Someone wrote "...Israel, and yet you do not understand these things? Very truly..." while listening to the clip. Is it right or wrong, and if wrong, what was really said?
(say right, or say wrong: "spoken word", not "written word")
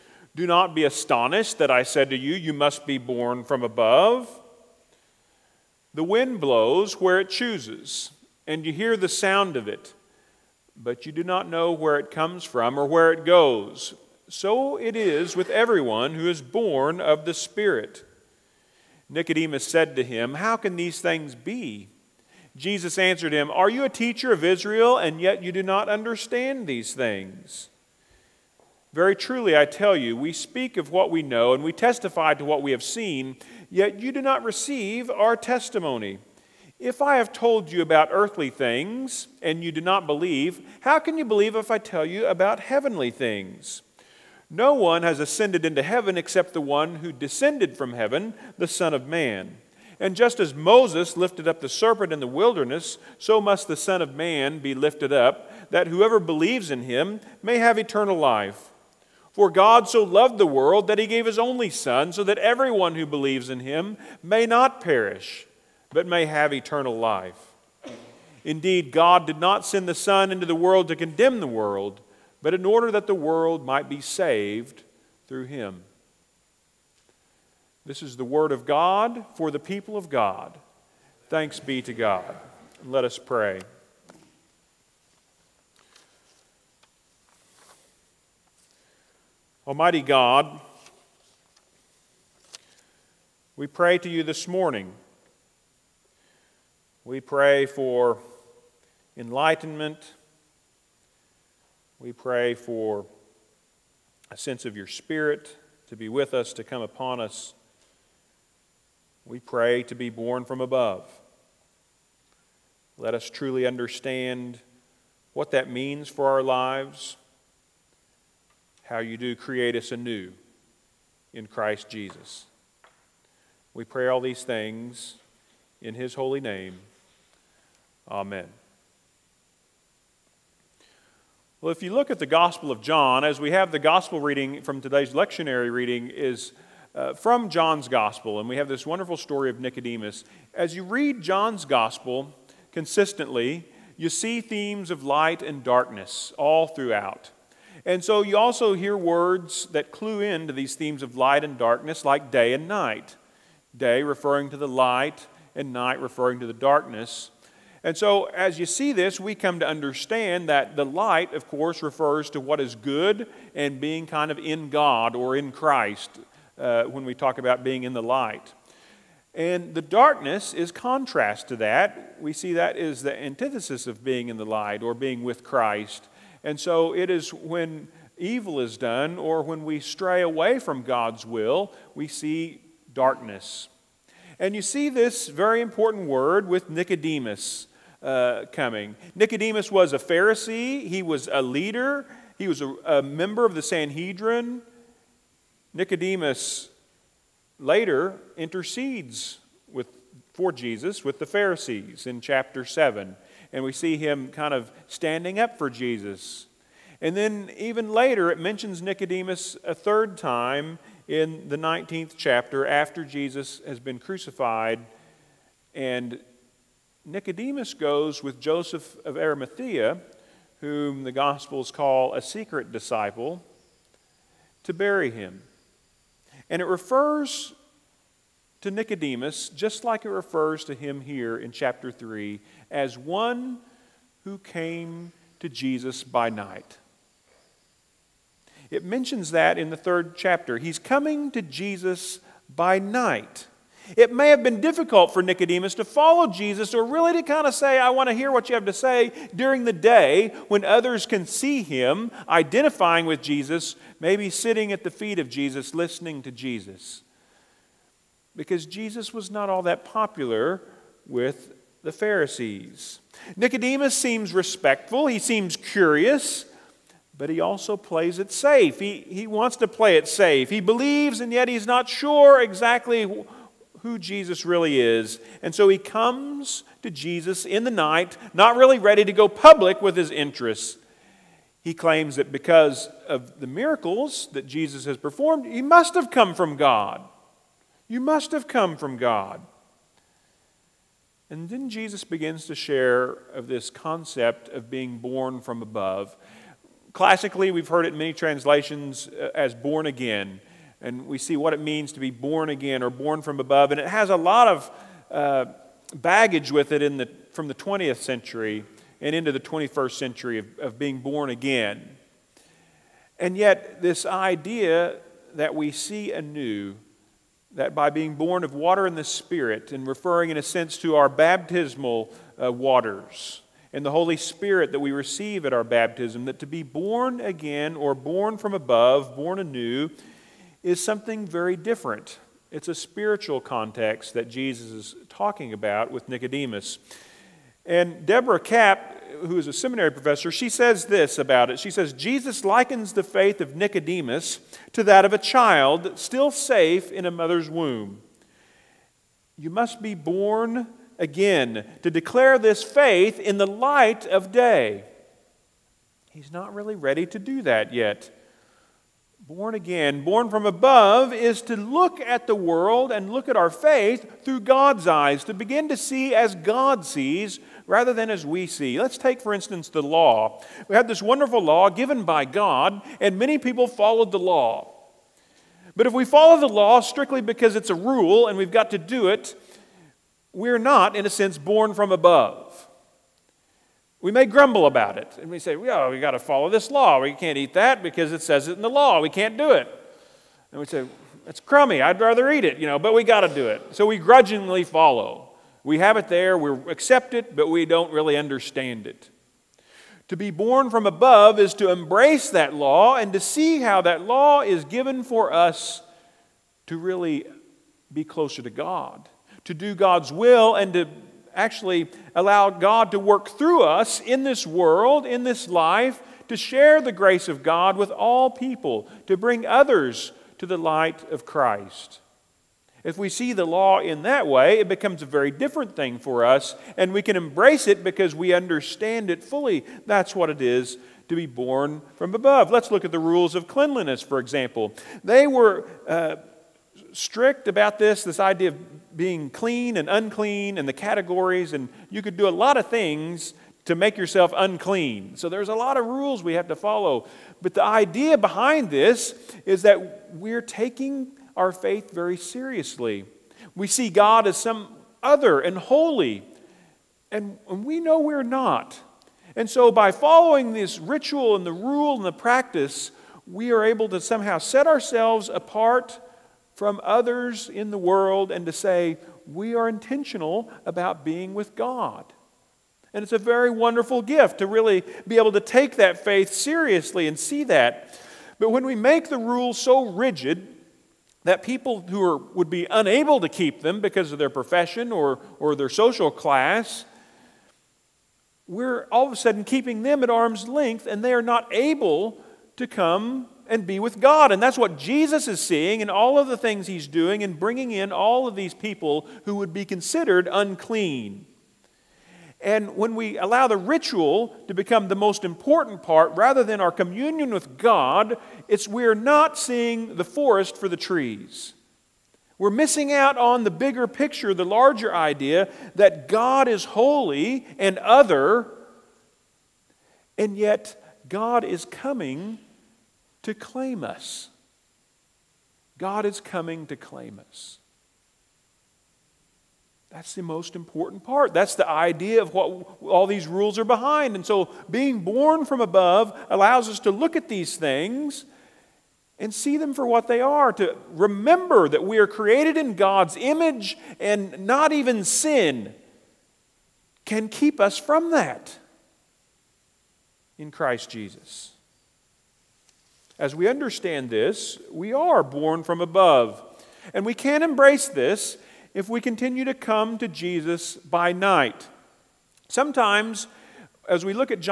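right.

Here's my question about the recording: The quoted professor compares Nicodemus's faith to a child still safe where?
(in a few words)
In a mother's womb.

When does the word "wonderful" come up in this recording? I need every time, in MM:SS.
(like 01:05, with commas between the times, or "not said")
02:18, 06:11, 07:53.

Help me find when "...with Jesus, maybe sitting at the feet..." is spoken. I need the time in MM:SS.
04:13.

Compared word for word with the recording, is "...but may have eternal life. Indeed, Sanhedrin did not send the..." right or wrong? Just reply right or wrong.
wrong.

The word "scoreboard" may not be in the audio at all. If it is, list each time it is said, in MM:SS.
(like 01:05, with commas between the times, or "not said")
not said.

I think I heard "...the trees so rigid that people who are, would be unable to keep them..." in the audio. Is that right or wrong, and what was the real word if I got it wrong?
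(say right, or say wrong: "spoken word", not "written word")
wrong: "rules", not "trees".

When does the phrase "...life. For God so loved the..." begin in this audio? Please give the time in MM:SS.
00:58.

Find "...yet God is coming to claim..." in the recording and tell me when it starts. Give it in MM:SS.
08:40.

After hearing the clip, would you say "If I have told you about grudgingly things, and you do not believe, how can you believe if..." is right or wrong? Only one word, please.
wrong.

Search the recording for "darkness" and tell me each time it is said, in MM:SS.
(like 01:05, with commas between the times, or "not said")
02:25, 02:31, 02:36, 02:49, 03:02.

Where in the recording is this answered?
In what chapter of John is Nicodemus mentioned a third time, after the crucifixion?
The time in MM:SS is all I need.
03:31.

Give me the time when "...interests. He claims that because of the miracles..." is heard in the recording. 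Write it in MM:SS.
04:40.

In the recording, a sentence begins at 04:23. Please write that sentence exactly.
Nicodemus seems respectful, he seems curious but he also plays it safe.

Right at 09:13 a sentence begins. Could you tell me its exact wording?
As we understand this, we are born from above.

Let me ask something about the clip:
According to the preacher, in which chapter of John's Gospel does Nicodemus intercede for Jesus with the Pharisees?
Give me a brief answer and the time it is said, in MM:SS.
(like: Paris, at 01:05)
Chapter 7, at 03:22.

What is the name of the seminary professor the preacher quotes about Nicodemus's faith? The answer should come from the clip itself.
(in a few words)
Deborah Kapp.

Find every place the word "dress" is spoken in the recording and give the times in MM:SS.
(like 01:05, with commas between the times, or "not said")
not said.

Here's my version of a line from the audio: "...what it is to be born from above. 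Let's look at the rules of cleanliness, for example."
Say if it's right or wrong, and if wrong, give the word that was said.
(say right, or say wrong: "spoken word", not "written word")
right.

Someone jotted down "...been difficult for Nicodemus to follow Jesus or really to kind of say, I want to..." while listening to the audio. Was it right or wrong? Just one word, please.
right.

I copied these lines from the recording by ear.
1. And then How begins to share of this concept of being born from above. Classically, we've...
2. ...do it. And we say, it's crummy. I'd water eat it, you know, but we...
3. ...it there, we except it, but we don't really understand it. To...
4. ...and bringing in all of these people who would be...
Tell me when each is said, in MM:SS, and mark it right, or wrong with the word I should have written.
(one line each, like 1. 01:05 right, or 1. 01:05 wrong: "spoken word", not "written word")
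1. 04:51 wrong: "Jesus", not "How"
2. 06:29 wrong: "rather", not "water"
3. 06:35 wrong: "accept", not "except"
4. 08:17 right.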